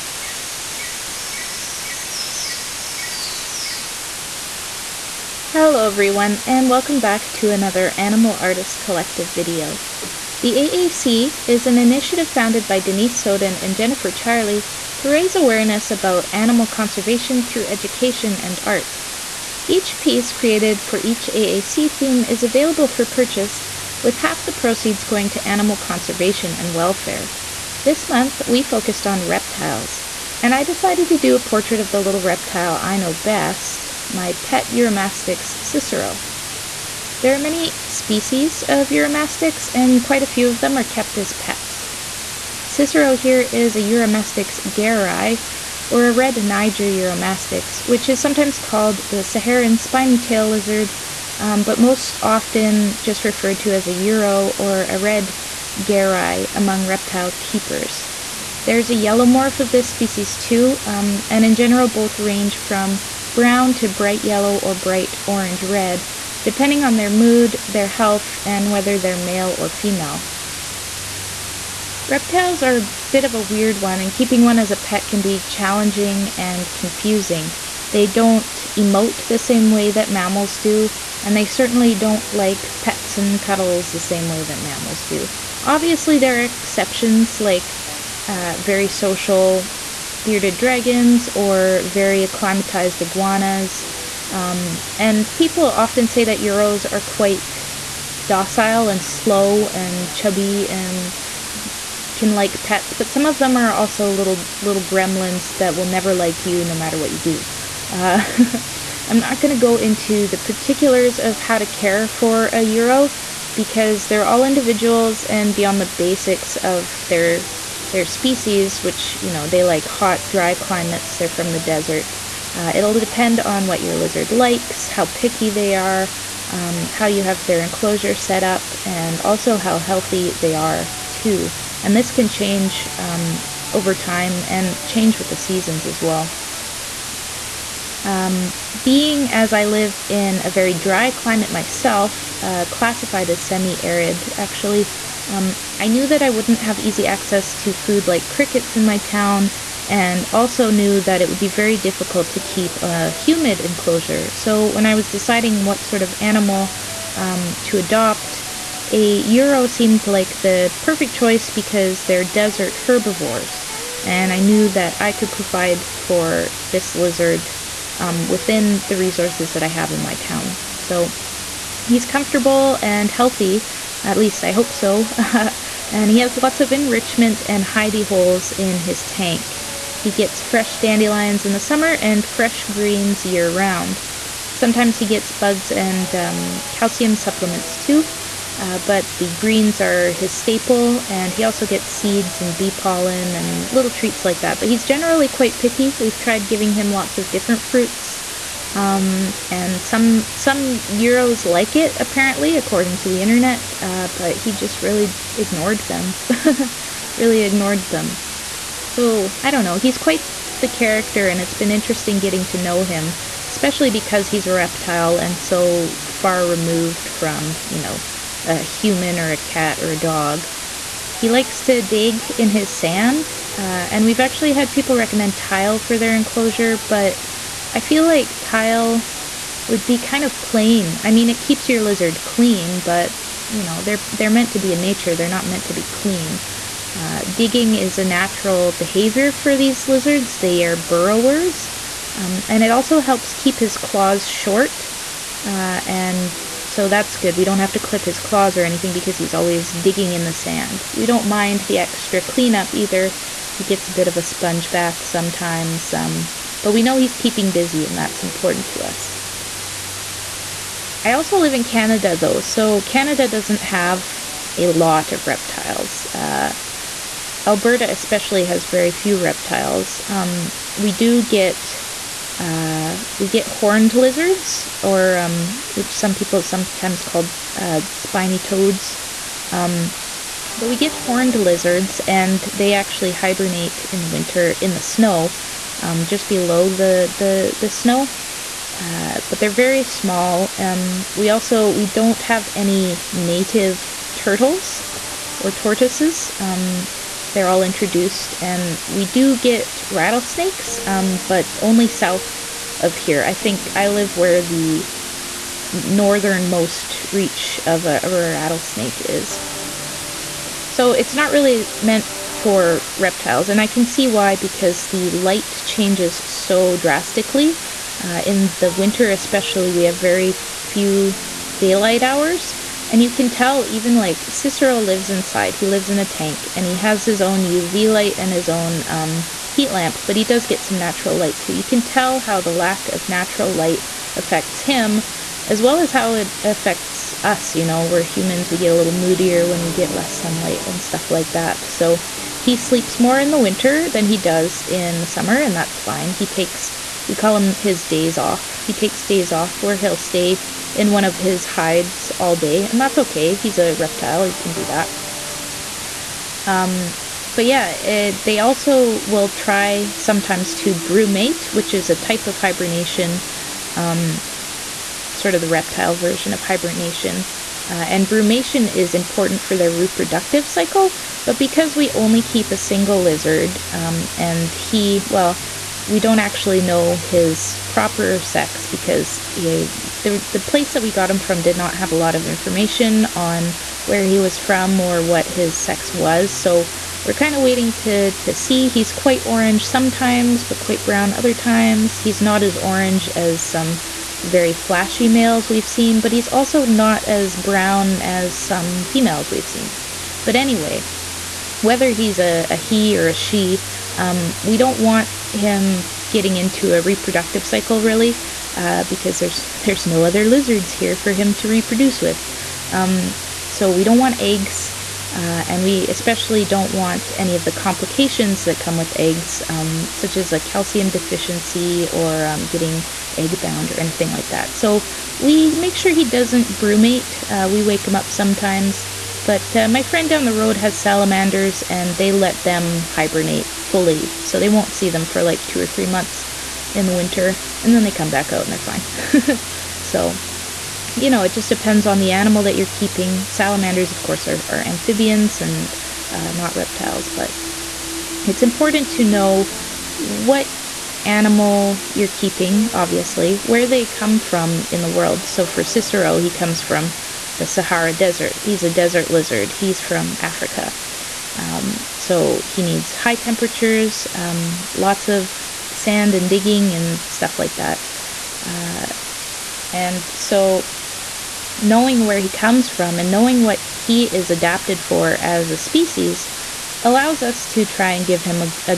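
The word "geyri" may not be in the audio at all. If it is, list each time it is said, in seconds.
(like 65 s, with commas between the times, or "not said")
44 s, 55 s.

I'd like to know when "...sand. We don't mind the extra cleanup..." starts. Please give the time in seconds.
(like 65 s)
250 s.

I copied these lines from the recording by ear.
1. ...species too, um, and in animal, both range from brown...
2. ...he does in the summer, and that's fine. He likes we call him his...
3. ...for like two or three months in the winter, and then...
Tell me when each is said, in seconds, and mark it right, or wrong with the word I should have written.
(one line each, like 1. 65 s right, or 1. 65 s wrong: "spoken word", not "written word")
1. 59 s wrong: "general", not "animal"
2. 344 s wrong: "takes", not "likes"
3. 435 s right.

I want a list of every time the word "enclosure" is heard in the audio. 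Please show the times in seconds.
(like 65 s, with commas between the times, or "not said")
127 s, 153 s, 226 s.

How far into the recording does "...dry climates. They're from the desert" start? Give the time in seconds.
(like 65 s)
120 s.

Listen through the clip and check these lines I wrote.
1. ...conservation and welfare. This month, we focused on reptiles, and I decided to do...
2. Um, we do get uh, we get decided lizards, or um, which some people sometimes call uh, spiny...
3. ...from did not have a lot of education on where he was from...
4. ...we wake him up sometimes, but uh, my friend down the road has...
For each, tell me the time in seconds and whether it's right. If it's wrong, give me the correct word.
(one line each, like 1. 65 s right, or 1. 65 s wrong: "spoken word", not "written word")
1. 25 s right
2. 270 s wrong: "horned", not "decided"
3. 381 s wrong: "information", not "education"
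4. 427 s right.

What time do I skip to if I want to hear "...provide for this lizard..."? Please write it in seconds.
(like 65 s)
165 s.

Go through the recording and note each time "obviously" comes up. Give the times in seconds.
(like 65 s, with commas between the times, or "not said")
85 s, 452 s.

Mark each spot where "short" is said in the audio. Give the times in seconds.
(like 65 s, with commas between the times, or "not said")
244 s.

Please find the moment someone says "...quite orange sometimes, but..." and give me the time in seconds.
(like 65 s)
388 s.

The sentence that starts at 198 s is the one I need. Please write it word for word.
Um, and some some euros like it apparently, according to the internet.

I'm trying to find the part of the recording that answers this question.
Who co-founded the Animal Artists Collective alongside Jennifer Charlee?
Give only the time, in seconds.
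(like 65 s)
12 s.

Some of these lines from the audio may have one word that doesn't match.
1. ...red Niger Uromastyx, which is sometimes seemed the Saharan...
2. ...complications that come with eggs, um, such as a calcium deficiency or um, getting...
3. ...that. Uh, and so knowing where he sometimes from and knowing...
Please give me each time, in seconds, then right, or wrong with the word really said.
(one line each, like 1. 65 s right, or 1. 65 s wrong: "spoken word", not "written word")
1. 46 s wrong: "called", not "seemed"
2. 417 s right
3. 467 s wrong: "comes", not "sometimes".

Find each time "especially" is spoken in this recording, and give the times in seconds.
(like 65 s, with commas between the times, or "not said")
213 s, 267 s, 319 s, 415 s.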